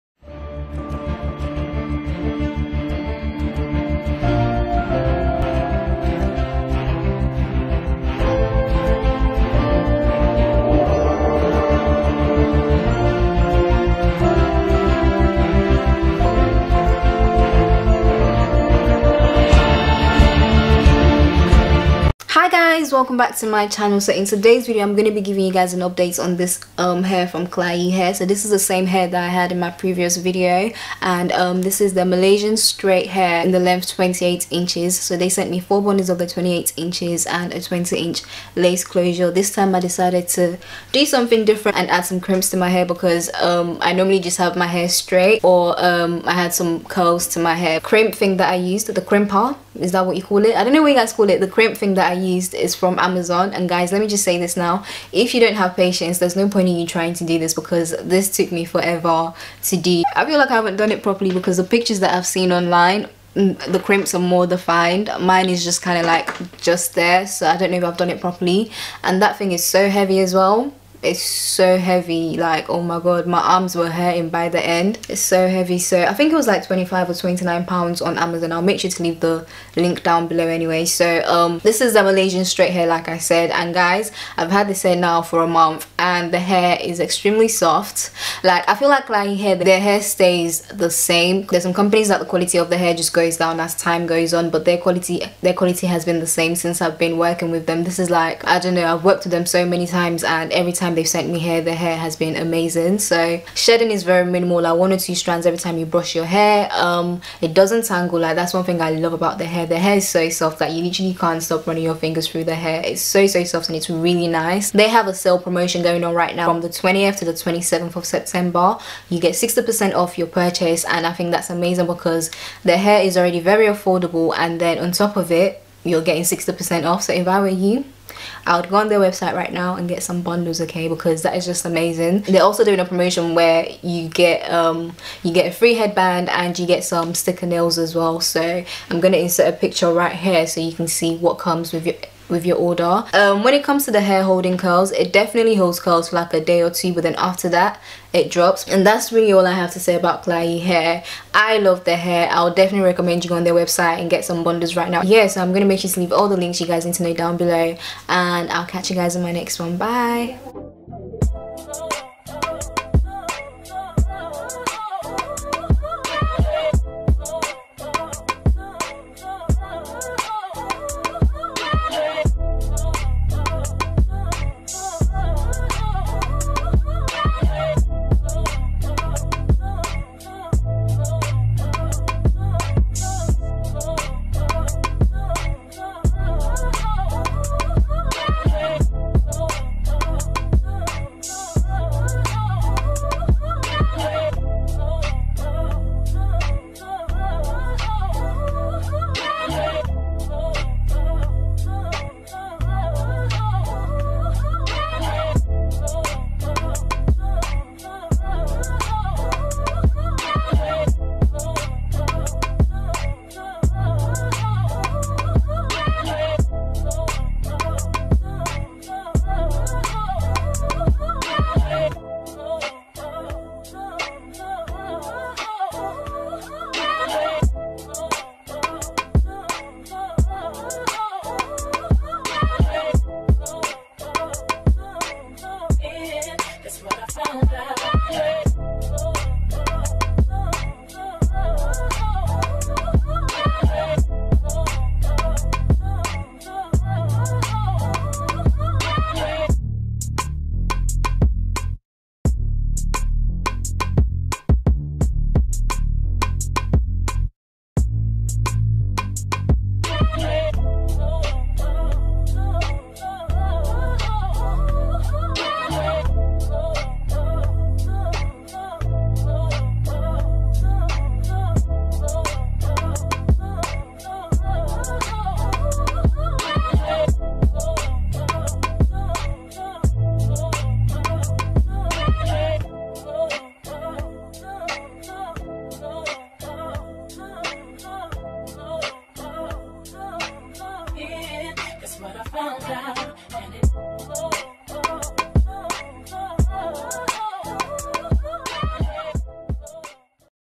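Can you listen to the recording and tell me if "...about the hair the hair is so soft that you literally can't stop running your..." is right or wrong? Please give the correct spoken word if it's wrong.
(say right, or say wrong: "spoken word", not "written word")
right.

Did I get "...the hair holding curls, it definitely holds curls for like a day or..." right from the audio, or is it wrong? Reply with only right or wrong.
right.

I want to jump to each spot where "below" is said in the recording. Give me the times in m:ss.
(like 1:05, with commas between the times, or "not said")
1:20, 2:37.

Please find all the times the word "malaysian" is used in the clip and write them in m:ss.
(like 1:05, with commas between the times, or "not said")
0:32, 1:22.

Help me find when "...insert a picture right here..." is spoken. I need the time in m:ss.
2:19.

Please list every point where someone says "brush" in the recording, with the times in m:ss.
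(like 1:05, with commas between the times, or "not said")
1:45.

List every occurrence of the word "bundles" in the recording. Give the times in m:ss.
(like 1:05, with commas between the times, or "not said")
0:35, 2:10, 2:34.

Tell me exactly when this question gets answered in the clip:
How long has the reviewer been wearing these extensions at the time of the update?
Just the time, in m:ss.
1:25.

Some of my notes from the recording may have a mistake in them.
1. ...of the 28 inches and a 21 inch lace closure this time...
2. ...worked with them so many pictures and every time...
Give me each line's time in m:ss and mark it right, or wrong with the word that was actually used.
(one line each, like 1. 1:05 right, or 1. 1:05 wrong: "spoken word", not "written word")
1. 0:36 wrong: "20", not "21"
2. 1:39 wrong: "times", not "pictures".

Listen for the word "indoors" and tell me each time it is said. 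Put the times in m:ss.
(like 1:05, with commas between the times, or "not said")
not said.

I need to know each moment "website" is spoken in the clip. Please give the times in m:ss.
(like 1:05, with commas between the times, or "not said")
2:08, 2:33.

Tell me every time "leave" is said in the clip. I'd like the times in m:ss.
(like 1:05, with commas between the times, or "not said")
1:19, 2:35.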